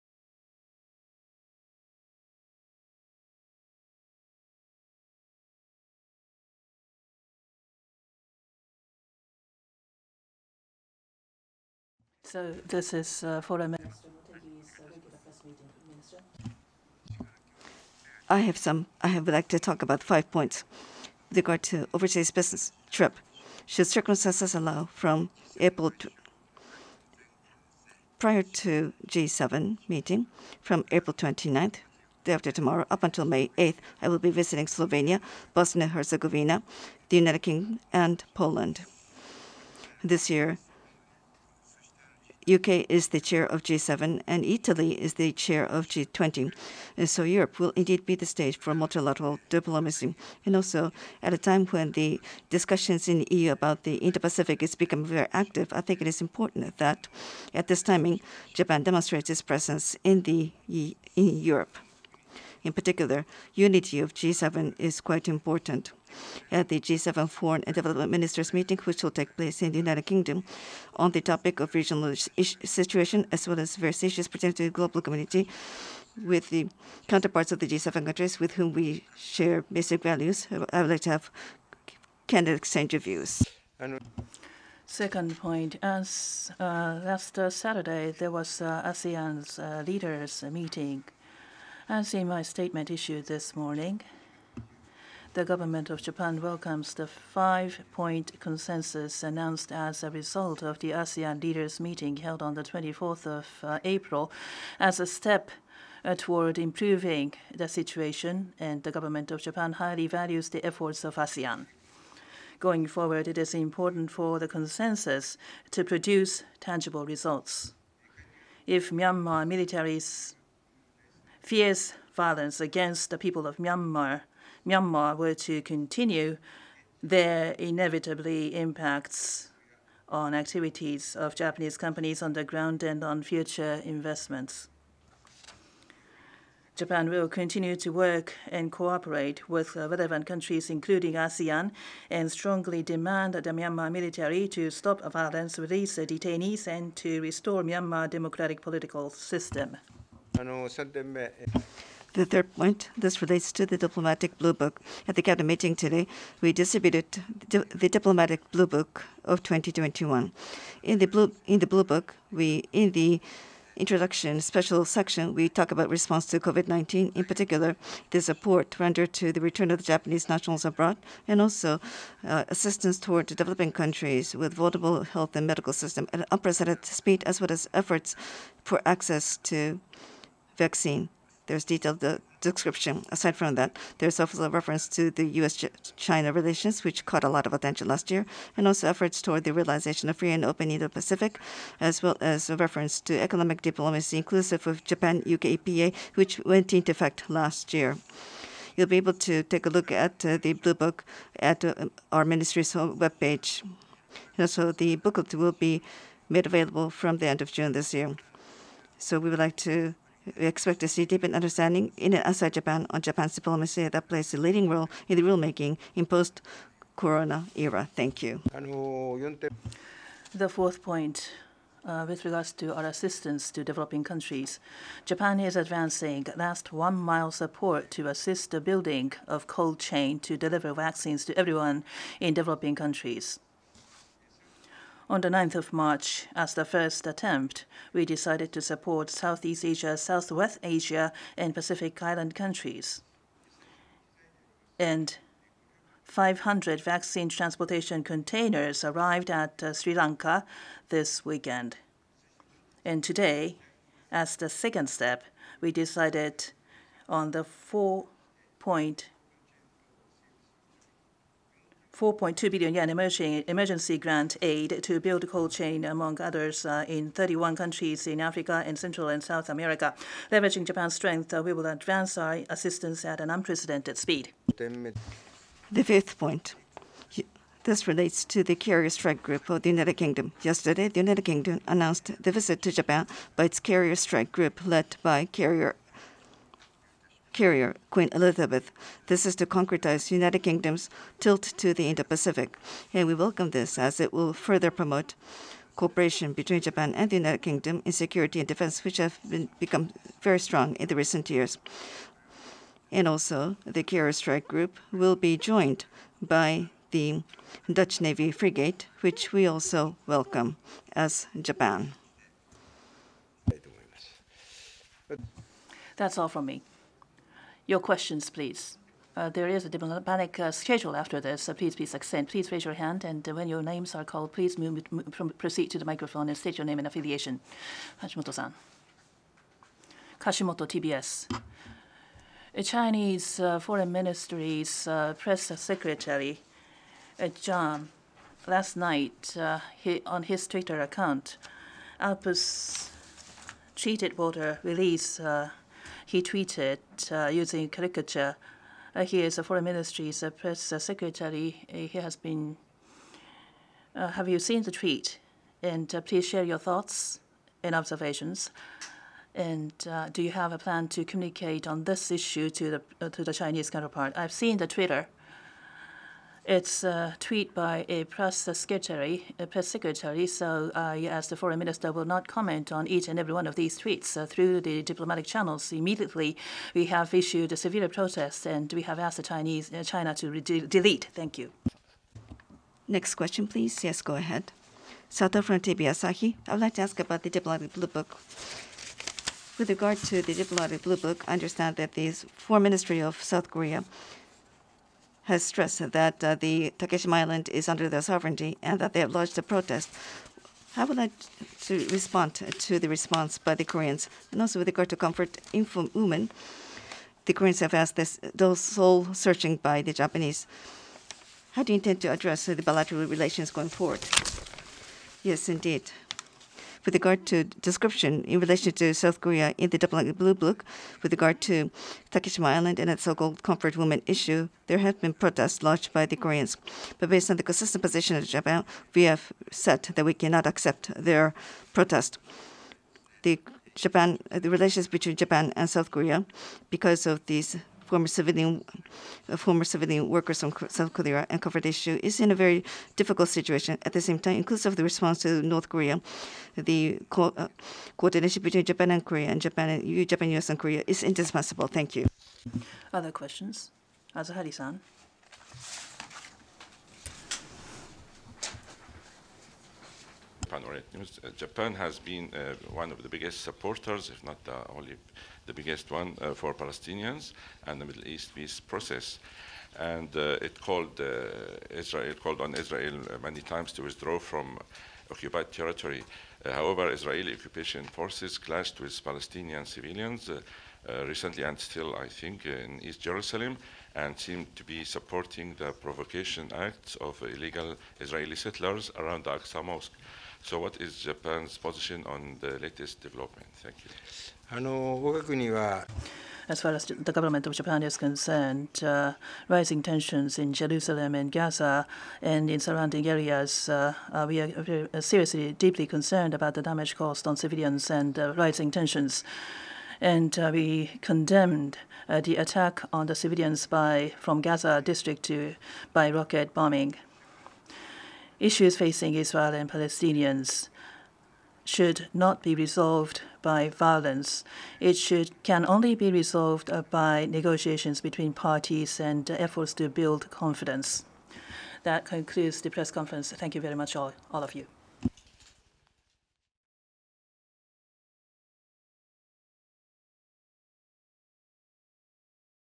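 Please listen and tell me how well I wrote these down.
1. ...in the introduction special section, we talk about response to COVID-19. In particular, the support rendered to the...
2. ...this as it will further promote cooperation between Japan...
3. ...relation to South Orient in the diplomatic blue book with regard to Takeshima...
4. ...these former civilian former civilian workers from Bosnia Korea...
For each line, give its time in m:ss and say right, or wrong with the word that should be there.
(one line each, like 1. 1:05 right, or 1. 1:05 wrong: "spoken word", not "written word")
1. 2:42 right
2. 4:53 right
3. 6:58 wrong: "Korea", not "Orient"
4. 7:17 wrong: "South", not "Bosnia".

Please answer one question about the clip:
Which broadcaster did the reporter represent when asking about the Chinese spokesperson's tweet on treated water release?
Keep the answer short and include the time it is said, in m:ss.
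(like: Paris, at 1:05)
TBS, at 5:30.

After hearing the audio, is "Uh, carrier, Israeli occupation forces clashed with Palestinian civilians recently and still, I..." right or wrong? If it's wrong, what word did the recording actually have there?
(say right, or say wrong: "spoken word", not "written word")
wrong: "however", not "carrier".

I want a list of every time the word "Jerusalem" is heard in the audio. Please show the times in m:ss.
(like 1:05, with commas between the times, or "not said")
8:03, 8:20.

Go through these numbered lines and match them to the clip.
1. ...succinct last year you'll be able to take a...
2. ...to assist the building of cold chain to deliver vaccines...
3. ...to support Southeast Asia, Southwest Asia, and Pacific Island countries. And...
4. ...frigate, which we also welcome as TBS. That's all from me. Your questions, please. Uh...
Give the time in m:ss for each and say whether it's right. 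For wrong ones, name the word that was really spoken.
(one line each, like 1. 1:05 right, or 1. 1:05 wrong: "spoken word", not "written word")
1. 3:16 wrong: "effect", not "succinct"
2. 3:47 right
3. 3:58 right
4. 5:08 wrong: "Japan", not "TBS".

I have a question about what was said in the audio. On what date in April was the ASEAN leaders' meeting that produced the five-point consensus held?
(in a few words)
24th.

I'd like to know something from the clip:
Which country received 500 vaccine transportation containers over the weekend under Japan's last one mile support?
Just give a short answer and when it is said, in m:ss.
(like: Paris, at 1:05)
Sri Lanka, at 4:09.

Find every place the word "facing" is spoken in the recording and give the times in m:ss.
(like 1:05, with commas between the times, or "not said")
8:38.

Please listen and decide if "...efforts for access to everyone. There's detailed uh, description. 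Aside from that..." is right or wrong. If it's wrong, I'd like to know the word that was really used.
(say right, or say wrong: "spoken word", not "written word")
wrong: "vaccine", not "everyone".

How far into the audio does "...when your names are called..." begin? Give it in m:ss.
5:23.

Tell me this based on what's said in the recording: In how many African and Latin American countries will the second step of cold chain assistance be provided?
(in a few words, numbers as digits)
31.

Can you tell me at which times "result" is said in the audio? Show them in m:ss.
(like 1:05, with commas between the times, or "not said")
1:40, 1:57.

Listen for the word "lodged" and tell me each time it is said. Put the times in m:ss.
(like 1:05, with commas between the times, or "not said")
6:39, 7:05.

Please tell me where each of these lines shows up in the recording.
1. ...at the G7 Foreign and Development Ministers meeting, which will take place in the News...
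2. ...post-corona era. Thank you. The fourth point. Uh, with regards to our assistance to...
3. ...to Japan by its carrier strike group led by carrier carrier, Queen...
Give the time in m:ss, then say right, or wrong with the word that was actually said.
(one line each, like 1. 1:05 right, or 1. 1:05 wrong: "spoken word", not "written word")
1. 1:06 wrong: "United", not "News"
2. 3:36 right
3. 4:42 right.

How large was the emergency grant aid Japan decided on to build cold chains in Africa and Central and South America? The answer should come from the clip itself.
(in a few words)
4.2 billion yen.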